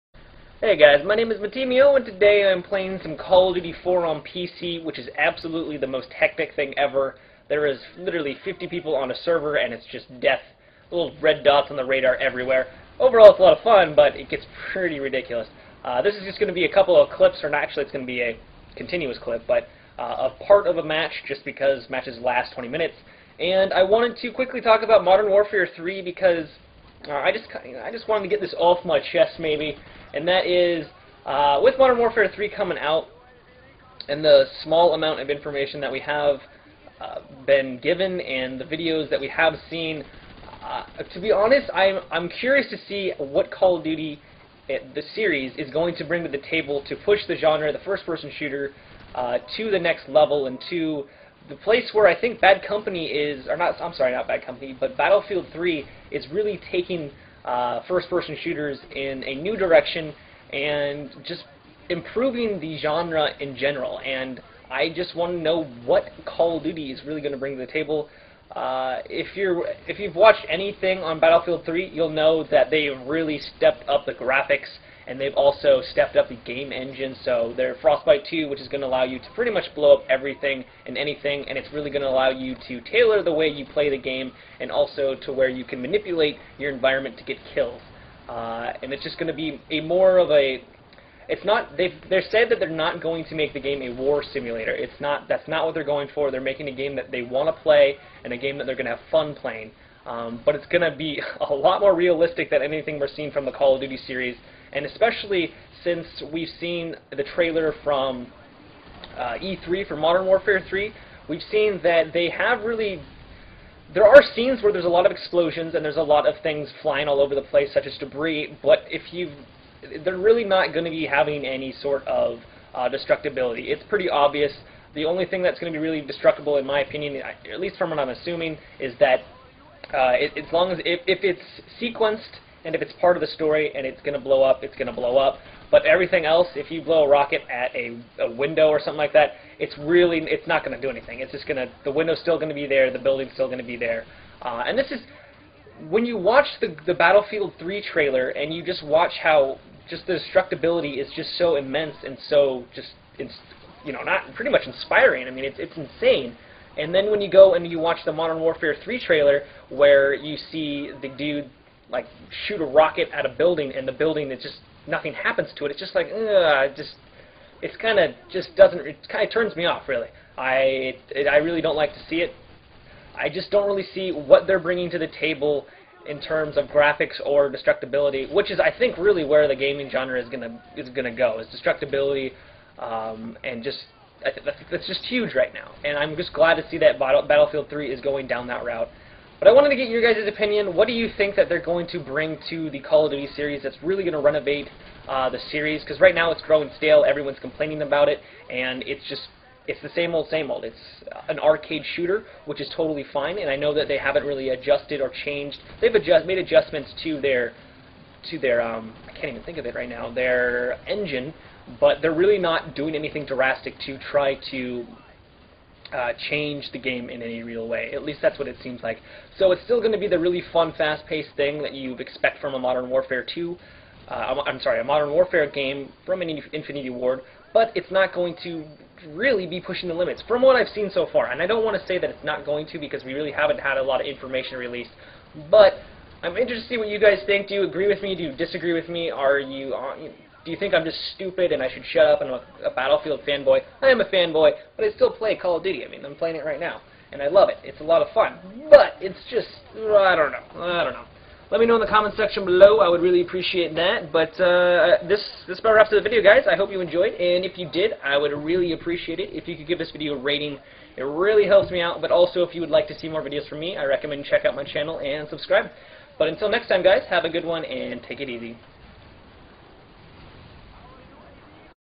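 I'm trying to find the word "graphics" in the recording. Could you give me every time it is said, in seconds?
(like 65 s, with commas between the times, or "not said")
74 s, 176 s.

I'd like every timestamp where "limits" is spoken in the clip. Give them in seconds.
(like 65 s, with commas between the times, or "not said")
229 s.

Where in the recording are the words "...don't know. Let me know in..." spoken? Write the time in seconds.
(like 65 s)
250 s.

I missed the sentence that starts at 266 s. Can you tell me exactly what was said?
But until next time, guys, have a good one and take it easy.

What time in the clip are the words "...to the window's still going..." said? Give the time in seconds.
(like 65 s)
141 s.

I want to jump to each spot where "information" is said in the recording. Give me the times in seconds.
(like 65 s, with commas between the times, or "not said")
35 s, 234 s.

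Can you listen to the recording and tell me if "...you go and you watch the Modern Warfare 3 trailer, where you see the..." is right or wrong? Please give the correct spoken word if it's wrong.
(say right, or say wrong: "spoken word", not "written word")
right.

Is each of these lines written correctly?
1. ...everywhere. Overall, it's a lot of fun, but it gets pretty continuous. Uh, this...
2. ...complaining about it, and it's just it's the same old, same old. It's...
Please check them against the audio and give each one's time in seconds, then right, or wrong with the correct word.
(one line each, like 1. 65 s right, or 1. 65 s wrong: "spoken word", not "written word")
1. 12 s wrong: "ridiculous", not "continuous"
2. 197 s right.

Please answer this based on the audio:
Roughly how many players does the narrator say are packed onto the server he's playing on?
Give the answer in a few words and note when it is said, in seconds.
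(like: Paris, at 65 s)
50, at 8 s.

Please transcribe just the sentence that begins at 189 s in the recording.
But I wanted to get your guys' opinion.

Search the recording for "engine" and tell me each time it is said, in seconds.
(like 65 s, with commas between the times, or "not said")
76 s, 210 s.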